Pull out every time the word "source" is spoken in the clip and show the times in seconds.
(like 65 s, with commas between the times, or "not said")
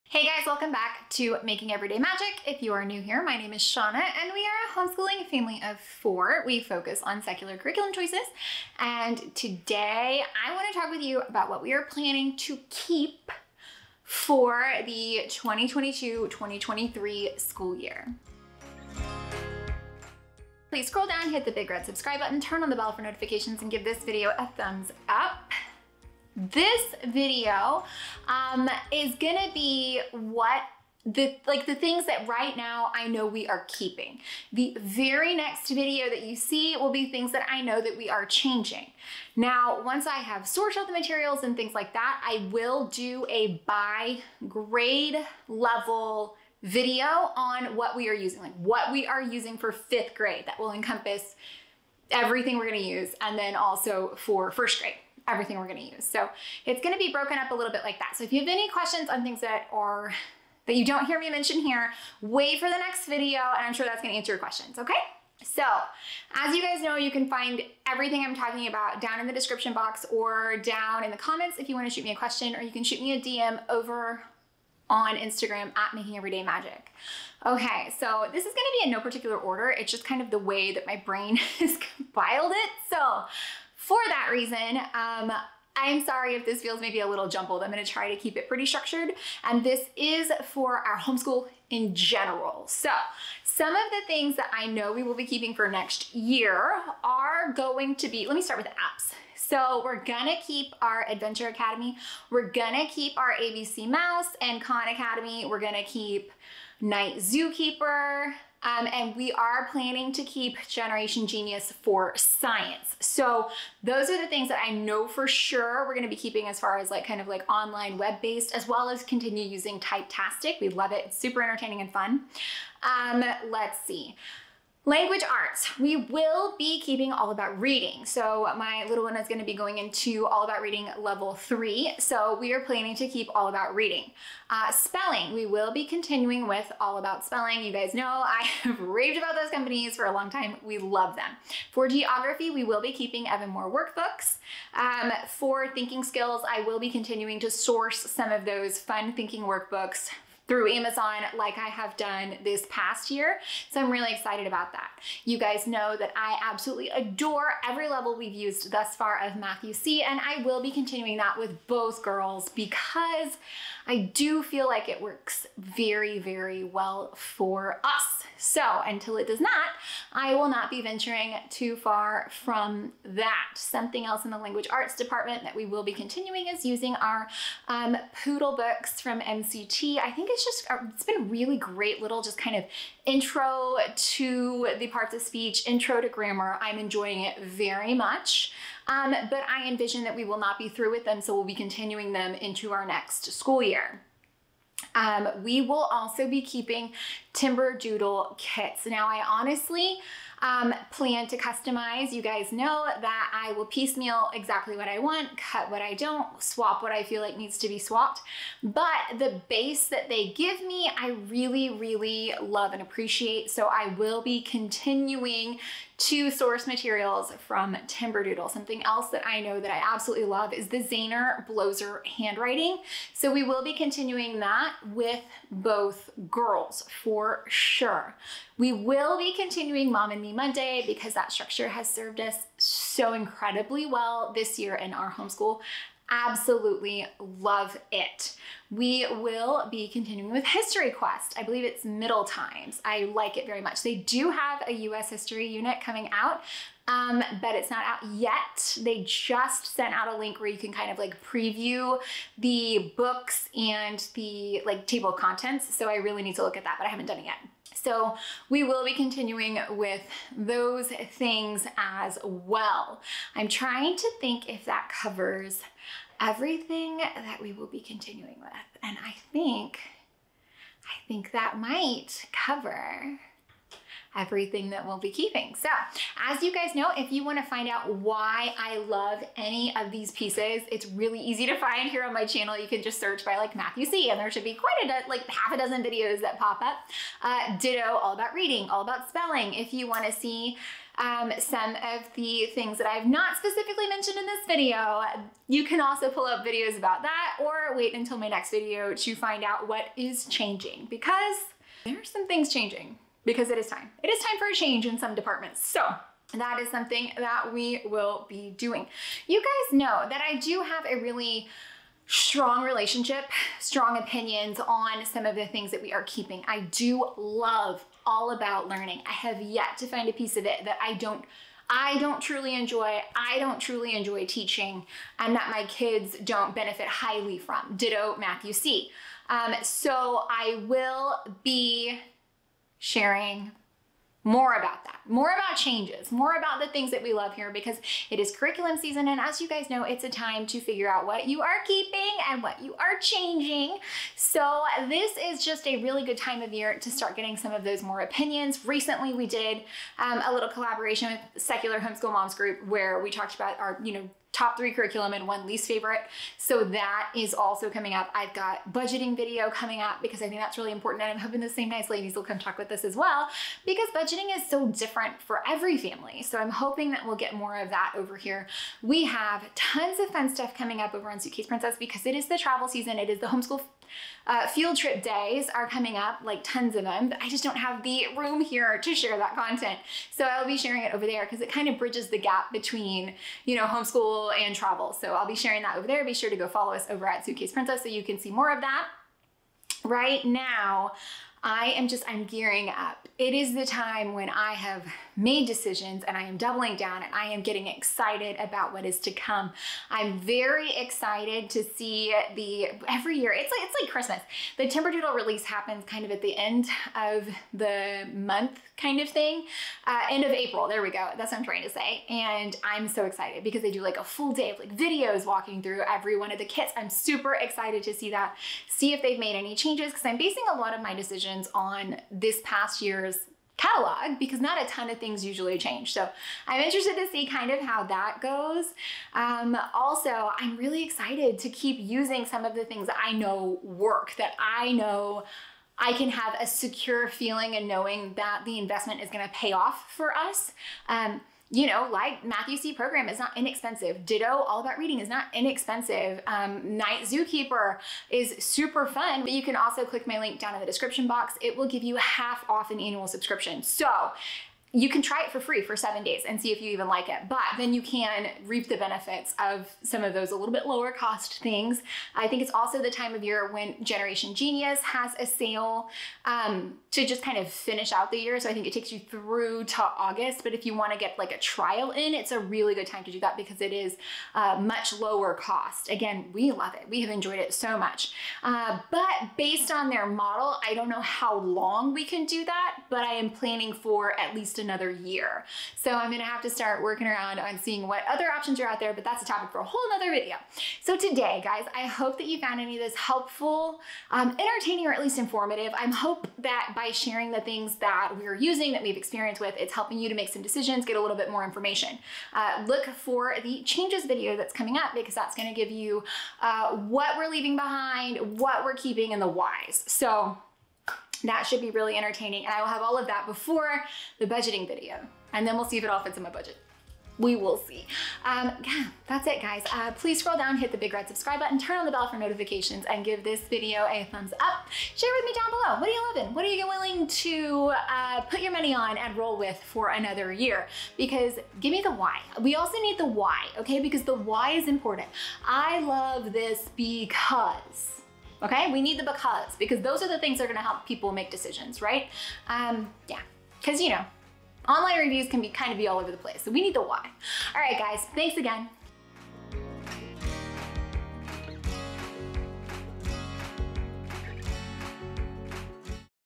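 147 s, 216 s.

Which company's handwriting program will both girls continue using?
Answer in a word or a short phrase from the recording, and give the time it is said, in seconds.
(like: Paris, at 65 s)
Zaner Bloser, at 220 s.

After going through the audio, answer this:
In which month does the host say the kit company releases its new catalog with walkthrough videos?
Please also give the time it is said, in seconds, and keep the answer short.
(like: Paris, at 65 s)
April, at 410 s.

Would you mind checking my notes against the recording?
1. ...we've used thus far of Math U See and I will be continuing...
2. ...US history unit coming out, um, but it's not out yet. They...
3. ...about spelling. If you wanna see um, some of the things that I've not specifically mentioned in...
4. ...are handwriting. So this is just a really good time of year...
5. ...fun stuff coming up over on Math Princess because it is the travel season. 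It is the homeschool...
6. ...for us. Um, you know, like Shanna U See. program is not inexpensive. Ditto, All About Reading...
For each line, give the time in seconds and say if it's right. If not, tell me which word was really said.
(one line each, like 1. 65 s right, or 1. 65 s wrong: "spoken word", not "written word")
1. 158 s right
2. 244 s right
3. 288 s right
4. 342 s wrong: "changing", not "handwriting"
5. 370 s wrong: "Suitcase", not "Math"
6. 439 s wrong: "Math", not "Shanna".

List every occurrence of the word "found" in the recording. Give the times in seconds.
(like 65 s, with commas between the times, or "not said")
492 s.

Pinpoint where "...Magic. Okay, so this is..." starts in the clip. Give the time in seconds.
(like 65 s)
76 s.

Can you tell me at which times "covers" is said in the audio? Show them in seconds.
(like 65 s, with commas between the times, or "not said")
265 s, 272 s.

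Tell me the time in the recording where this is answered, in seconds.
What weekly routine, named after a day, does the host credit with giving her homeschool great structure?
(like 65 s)
229 s.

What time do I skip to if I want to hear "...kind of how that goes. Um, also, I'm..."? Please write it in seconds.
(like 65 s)
427 s.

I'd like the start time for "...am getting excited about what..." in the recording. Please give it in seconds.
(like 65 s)
397 s.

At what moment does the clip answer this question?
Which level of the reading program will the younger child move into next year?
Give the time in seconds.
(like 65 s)
130 s.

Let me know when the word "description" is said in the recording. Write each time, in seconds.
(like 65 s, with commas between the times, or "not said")
69 s, 450 s.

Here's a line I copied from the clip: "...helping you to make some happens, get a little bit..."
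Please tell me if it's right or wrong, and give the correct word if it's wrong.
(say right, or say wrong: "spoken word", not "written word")
wrong: "decisions", not "happens".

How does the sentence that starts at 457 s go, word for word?
But then you can reap the benefits of some of those a little bit lower cost things.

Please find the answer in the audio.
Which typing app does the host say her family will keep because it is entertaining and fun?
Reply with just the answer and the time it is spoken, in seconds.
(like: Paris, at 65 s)
Typetastic, at 119 s.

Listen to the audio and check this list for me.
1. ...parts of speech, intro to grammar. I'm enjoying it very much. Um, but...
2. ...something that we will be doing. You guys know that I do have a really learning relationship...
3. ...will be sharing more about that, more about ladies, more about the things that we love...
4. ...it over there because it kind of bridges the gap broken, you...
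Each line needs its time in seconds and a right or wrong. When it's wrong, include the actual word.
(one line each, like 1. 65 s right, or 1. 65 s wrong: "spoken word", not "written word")
1. 184 s right
2. 306 s wrong: "strong", not "learning"
3. 330 s wrong: "changes", not "ladies"
4. 380 s wrong: "between", not "broken".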